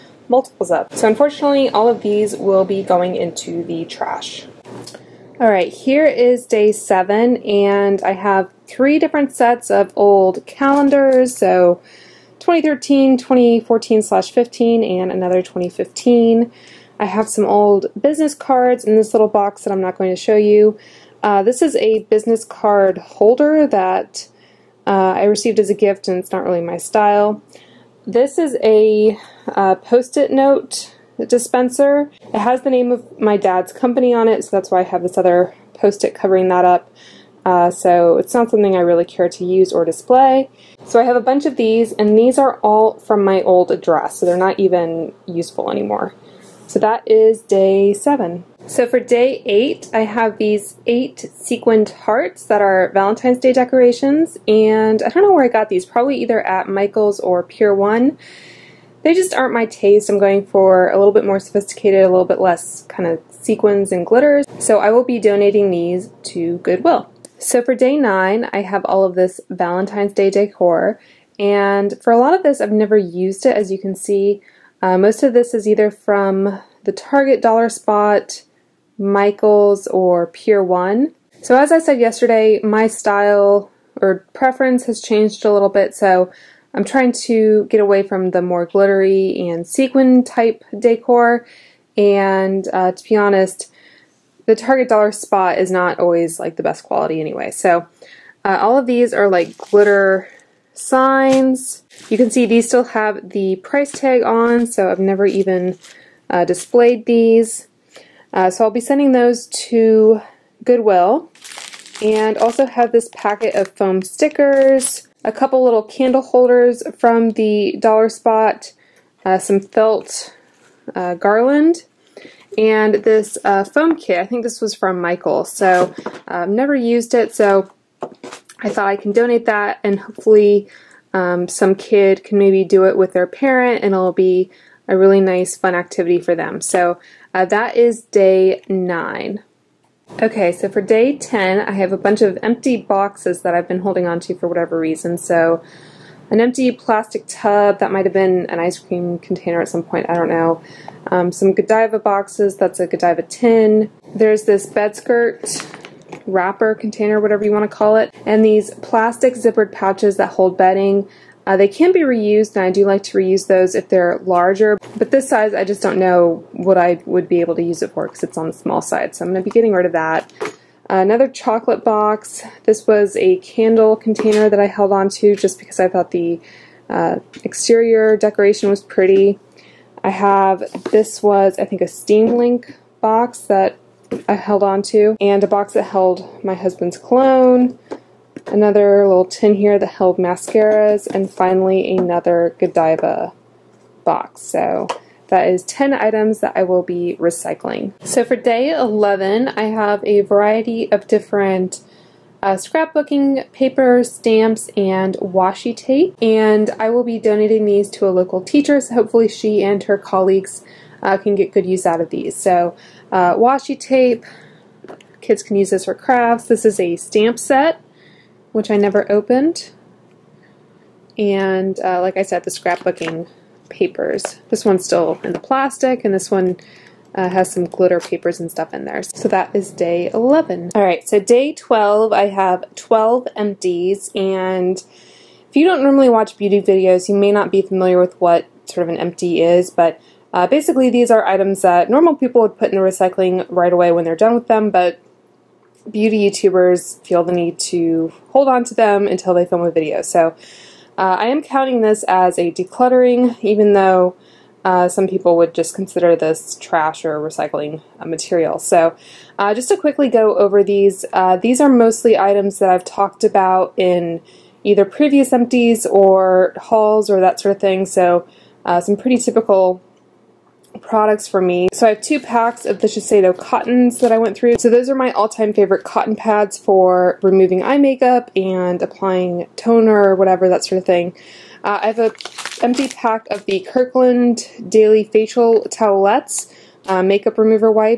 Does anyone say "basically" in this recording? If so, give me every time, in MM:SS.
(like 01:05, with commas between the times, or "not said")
04:00.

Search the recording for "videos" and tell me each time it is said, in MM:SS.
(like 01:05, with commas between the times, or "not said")
03:56, 04:09.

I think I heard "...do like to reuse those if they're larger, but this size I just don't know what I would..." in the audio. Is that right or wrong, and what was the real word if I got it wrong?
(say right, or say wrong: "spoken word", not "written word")
right.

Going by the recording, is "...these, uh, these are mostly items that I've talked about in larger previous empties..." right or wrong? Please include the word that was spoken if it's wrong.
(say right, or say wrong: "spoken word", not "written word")
wrong: "either", not "larger".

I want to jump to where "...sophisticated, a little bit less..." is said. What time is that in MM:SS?
01:01.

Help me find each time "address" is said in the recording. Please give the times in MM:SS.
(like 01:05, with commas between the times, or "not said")
00:43.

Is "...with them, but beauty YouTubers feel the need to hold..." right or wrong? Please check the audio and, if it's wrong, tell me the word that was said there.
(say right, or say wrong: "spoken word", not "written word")
right.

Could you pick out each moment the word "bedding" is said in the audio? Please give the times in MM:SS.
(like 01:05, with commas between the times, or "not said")
02:40.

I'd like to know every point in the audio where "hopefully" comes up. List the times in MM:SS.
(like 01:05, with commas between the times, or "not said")
02:09, 03:28.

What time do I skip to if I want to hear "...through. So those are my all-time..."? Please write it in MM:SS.
04:34.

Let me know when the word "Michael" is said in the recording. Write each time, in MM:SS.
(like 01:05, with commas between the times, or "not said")
00:56, 01:18, 02:05.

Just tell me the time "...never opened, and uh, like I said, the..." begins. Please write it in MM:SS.
03:38.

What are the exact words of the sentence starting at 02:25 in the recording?
So an empty plastic tub that might have been an ice cream container at some point, I don't know.